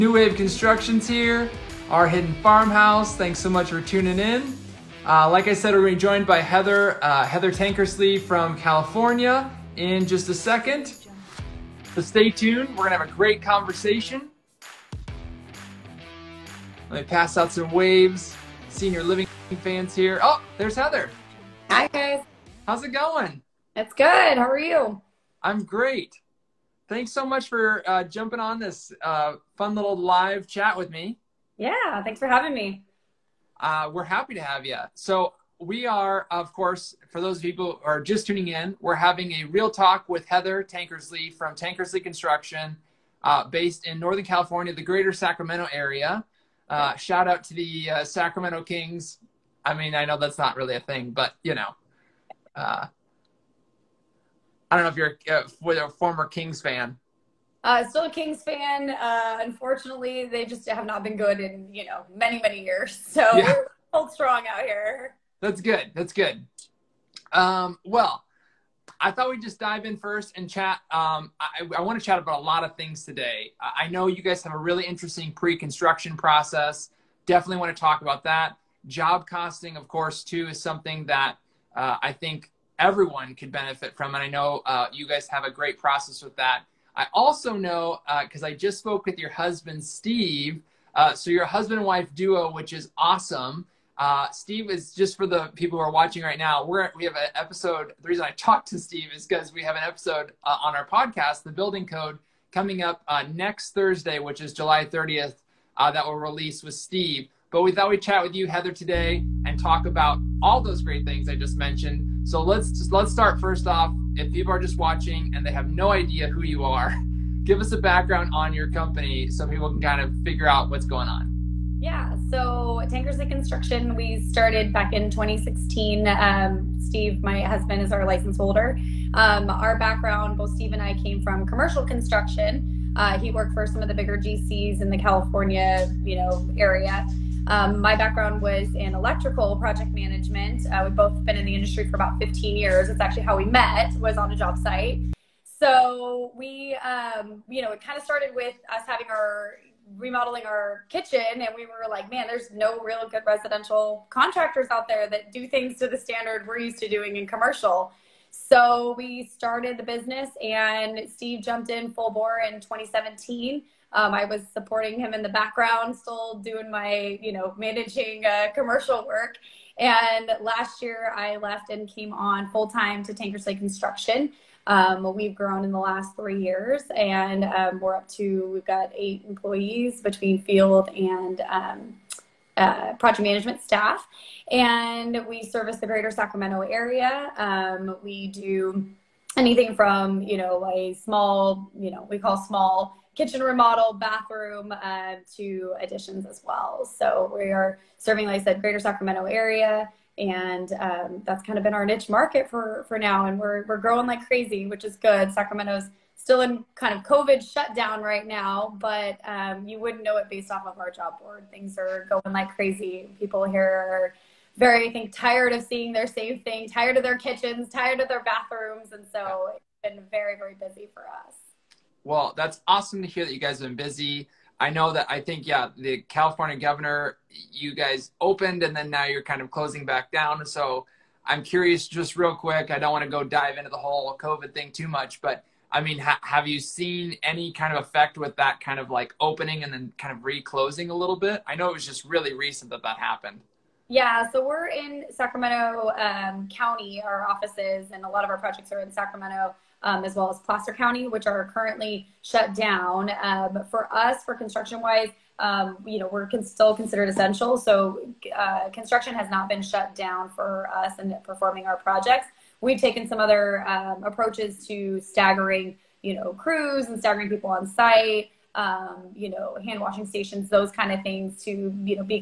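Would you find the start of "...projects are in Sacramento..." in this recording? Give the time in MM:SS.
04:08.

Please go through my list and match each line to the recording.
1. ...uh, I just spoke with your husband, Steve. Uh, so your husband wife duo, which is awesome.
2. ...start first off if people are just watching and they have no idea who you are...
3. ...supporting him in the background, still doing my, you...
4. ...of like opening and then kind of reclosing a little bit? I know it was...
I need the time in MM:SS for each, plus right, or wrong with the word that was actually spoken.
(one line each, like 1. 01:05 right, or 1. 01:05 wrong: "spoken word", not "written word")
1. 01:28 right
2. 01:53 right
3. 02:44 right
4. 03:58 right.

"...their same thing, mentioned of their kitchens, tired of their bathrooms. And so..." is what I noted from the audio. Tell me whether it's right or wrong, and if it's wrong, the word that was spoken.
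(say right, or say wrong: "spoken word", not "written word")
wrong: "tired", not "mentioned".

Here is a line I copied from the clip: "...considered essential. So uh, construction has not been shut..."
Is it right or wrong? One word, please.
right.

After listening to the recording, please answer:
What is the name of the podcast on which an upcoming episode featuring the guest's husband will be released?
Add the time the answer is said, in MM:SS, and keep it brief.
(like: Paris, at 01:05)
The Building Code, at 01:41.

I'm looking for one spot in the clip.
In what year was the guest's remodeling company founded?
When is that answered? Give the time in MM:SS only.
02:05.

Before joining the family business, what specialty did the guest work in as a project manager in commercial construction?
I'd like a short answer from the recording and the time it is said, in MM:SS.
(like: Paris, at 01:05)
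Electrical, at 02:18.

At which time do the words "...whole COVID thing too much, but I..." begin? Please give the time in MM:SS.
03:53.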